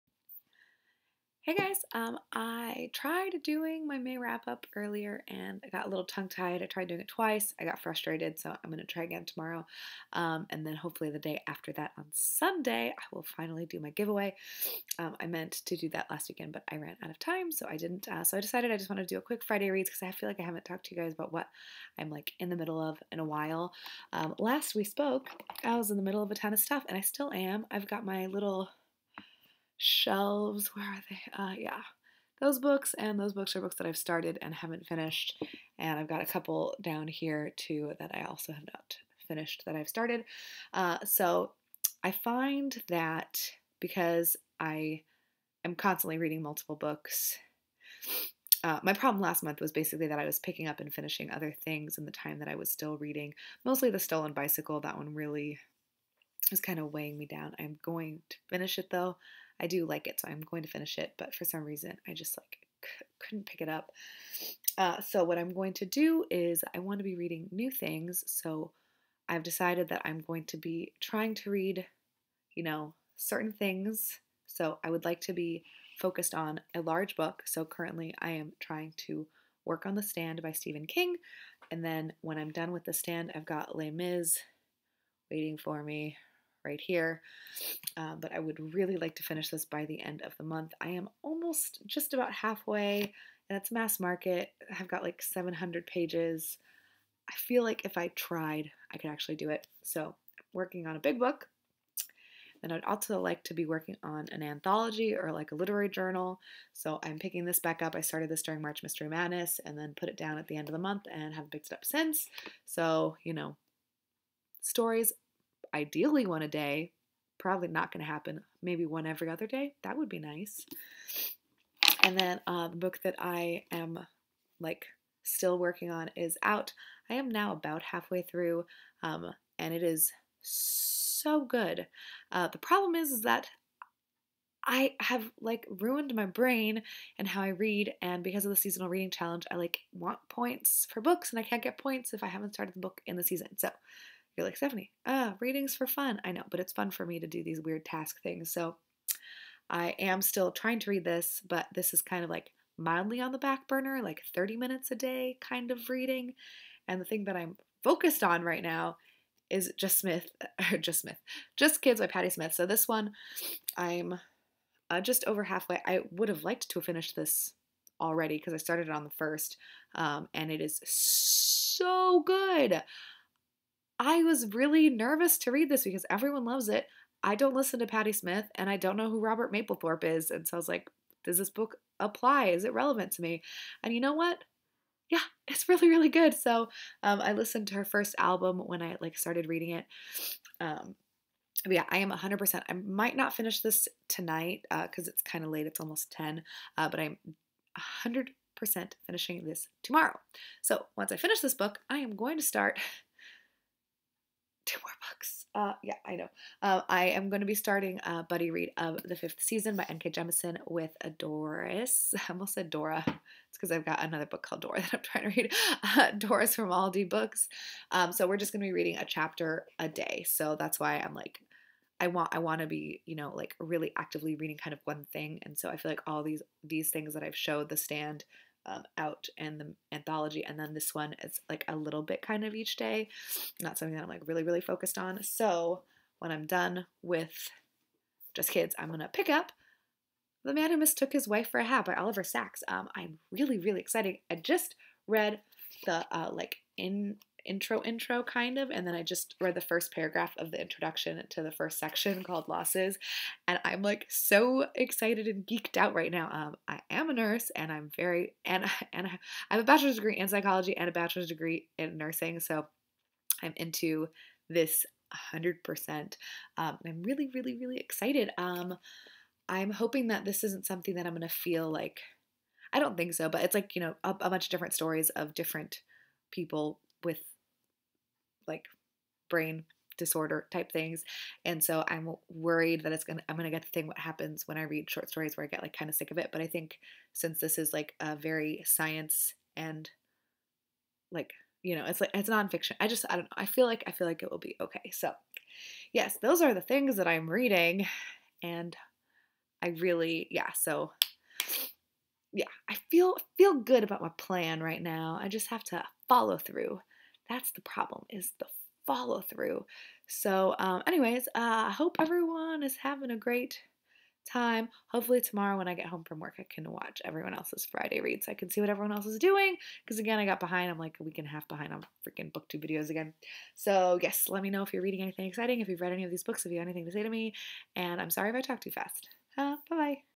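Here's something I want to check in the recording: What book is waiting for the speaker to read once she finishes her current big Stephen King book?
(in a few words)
Les Mis.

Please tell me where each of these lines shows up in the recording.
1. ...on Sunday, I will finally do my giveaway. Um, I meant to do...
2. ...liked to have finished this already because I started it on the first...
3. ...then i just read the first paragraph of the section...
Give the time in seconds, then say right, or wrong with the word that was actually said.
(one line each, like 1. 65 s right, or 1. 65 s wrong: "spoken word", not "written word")
1. 11 s right
2. 166 s right
3. 248 s wrong: "introduction", not "section".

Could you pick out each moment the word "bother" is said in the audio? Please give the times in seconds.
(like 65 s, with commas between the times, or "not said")
not said.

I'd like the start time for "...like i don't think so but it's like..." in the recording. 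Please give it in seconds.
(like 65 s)
271 s.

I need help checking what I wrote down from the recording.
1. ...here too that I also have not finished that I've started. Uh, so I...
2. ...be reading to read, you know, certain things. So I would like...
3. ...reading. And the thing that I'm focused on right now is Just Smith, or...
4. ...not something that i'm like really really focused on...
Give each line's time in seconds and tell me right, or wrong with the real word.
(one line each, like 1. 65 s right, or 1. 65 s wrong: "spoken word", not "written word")
1. 37 s right
2. 70 s wrong: "trying", not "reading"
3. 155 s right
4. 233 s right.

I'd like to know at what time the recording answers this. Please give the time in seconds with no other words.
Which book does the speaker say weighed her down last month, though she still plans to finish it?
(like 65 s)
53 s.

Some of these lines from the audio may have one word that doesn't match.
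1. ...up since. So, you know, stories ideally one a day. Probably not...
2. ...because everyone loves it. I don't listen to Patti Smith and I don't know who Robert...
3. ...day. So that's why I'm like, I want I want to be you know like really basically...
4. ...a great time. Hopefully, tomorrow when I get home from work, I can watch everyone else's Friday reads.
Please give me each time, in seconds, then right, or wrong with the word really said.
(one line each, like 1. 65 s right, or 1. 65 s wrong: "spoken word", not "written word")
1. 111 s right
2. 175 s right
3. 219 s wrong: "actively", not "basically"
4. 313 s right.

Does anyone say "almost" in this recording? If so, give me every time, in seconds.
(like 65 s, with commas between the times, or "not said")
91 s, 195 s, 212 s.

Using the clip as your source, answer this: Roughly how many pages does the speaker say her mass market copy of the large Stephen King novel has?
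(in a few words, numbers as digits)
700.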